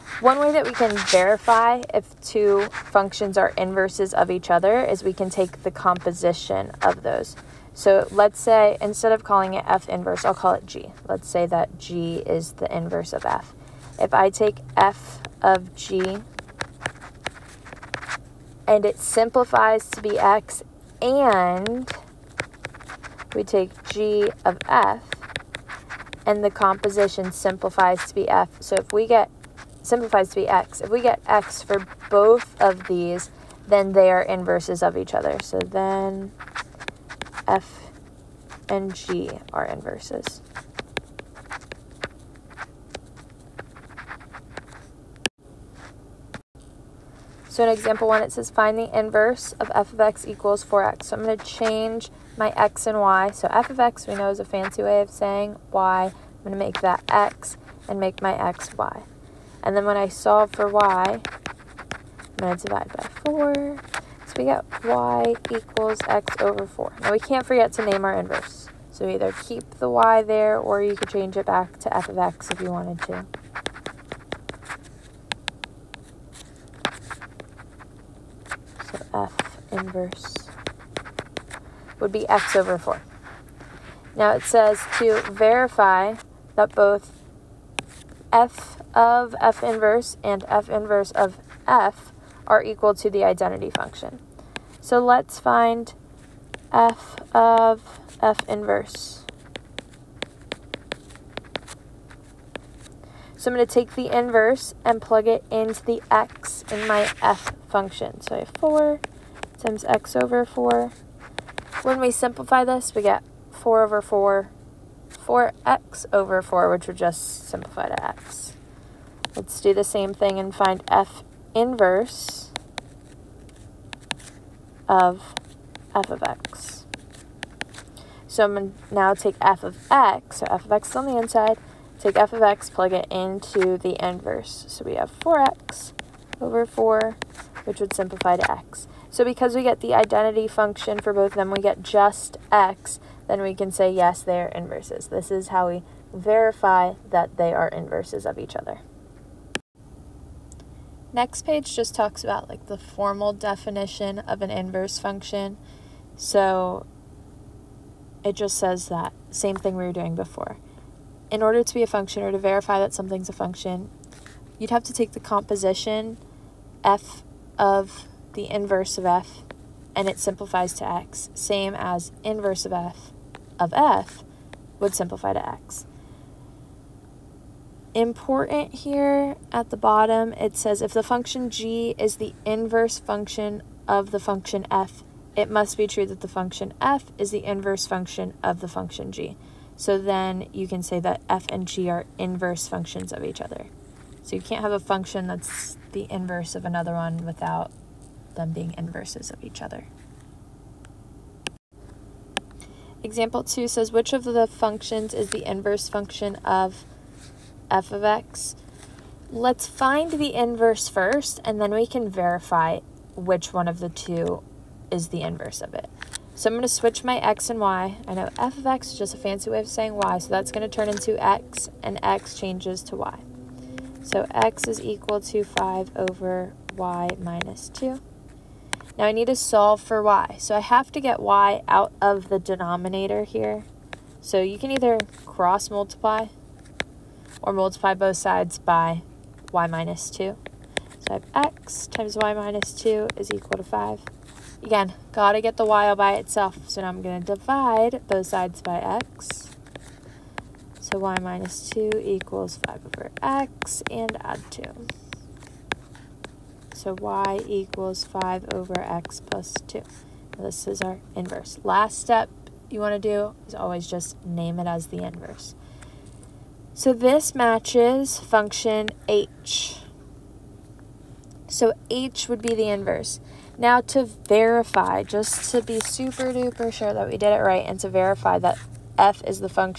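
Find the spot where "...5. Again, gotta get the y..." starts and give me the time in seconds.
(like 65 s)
243 s.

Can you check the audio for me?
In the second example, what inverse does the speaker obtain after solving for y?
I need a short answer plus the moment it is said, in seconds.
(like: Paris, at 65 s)
5/x + 2, at 256 s.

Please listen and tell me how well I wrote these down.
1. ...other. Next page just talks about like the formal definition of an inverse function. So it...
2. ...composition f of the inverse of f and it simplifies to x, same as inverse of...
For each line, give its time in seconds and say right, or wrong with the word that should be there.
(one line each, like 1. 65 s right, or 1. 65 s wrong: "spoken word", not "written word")
1. 148 s right
2. 165 s right.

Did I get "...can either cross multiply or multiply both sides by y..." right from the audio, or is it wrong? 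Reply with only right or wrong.
right.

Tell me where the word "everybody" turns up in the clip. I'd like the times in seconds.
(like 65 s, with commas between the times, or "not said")
not said.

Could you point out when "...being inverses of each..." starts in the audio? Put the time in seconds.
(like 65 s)
198 s.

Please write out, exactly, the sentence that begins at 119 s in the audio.
Let's do the same thing and find f inverse of f of x.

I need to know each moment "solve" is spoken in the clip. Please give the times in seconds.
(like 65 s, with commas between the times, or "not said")
60 s, 229 s.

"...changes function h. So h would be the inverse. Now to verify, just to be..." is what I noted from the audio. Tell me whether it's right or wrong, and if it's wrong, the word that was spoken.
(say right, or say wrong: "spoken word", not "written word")
wrong: "matches", not "changes".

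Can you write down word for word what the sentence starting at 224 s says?
So x is equal to 5 over y minus 2.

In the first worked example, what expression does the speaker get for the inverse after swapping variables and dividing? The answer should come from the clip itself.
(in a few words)
x/4.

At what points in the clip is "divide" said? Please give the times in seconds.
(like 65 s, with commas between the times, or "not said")
62 s, 247 s.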